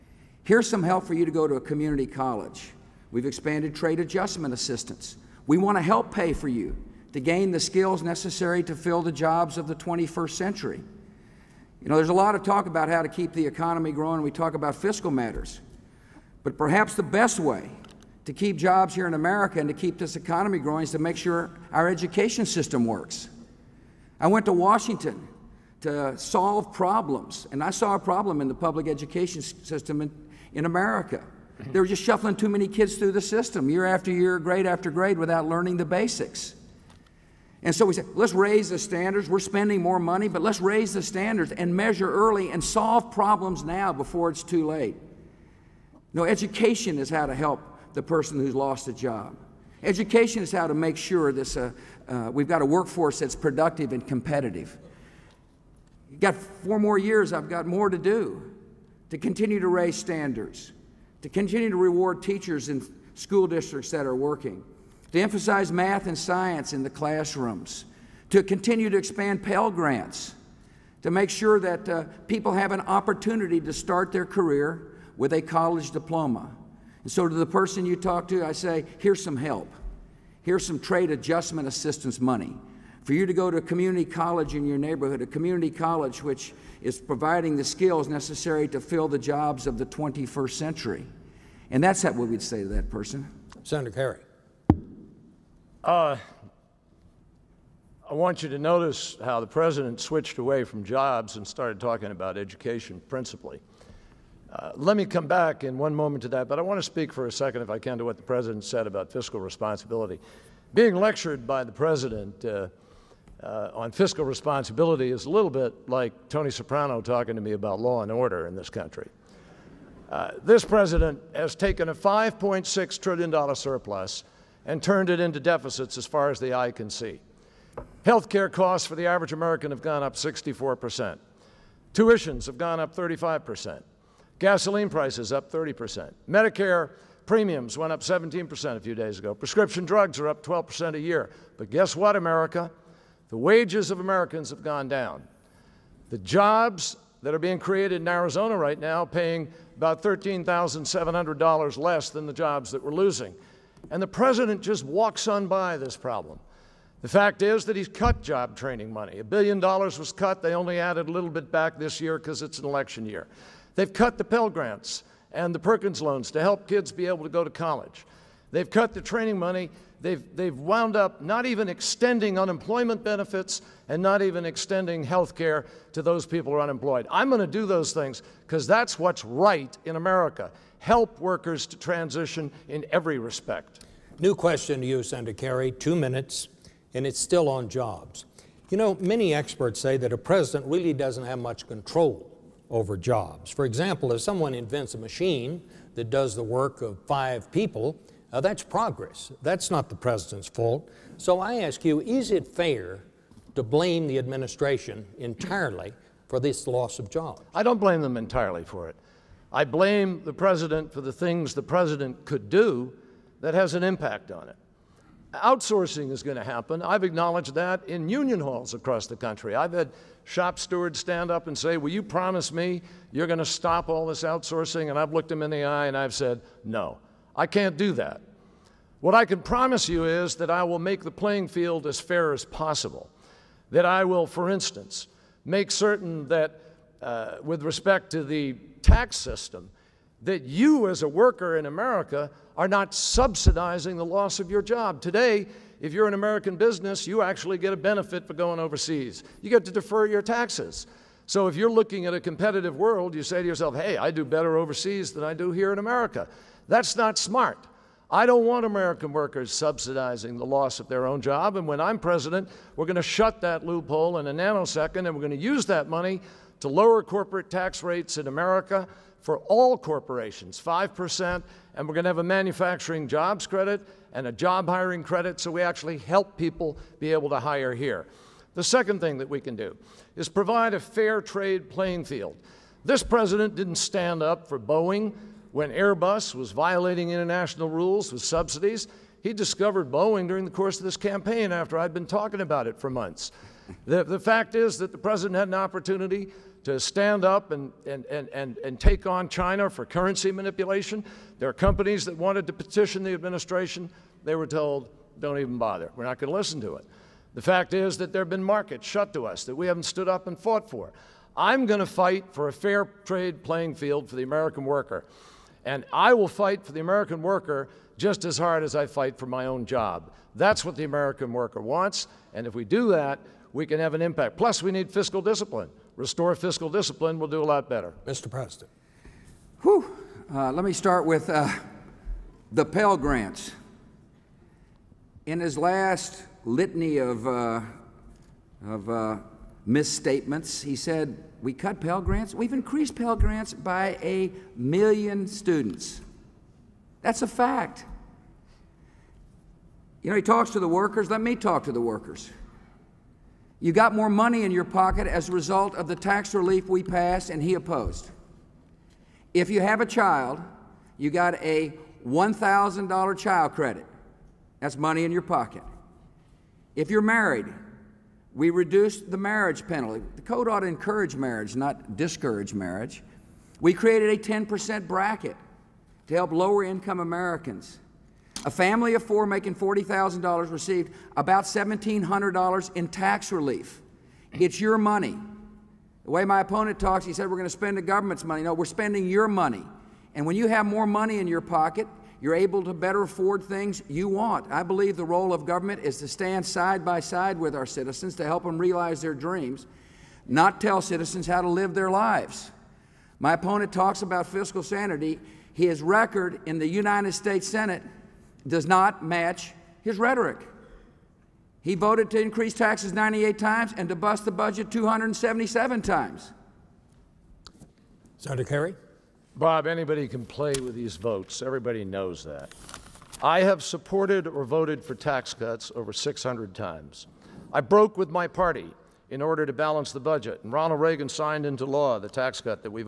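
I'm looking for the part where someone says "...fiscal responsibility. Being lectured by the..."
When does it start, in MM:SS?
01:49.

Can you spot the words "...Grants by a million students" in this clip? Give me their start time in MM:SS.
05:43.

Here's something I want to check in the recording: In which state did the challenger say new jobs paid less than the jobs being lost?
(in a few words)
Arizona.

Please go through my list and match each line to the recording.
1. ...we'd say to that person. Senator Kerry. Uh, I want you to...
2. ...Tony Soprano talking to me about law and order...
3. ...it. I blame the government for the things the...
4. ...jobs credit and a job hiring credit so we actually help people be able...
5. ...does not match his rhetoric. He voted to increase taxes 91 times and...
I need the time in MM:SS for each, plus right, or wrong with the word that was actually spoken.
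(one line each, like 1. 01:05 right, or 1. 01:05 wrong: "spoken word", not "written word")
1. 01:32 right
2. 01:56 right
3. 03:28 wrong: "president", not "government"
4. 04:33 right
5. 06:48 wrong: "98", not "91".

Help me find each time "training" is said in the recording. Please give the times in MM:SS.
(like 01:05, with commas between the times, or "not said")
02:38, 02:48.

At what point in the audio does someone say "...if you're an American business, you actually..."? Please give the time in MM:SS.
04:05.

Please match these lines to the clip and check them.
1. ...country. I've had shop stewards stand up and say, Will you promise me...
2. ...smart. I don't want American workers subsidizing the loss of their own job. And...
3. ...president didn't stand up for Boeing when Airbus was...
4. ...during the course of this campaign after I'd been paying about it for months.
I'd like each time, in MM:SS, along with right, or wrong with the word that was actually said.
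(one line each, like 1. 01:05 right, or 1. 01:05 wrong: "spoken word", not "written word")
1. 03:39 right
2. 04:17 right
3. 04:43 right
4. 04:50 wrong: "talking", not "paying".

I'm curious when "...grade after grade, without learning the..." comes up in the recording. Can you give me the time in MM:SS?
00:34.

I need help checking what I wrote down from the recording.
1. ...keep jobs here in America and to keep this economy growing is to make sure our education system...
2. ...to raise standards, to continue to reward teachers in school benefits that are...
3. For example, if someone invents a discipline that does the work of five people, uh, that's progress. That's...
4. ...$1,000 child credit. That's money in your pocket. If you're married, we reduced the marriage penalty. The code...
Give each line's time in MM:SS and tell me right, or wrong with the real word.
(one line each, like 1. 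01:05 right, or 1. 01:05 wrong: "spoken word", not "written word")
1. 00:18 right
2. 00:59 wrong: "districts", not "benefits"
3. 03:13 wrong: "machine", not "discipline"
4. 06:02 right.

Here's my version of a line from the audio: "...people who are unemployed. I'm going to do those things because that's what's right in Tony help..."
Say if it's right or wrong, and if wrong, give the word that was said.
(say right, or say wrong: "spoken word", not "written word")
wrong: "America", not "Tony".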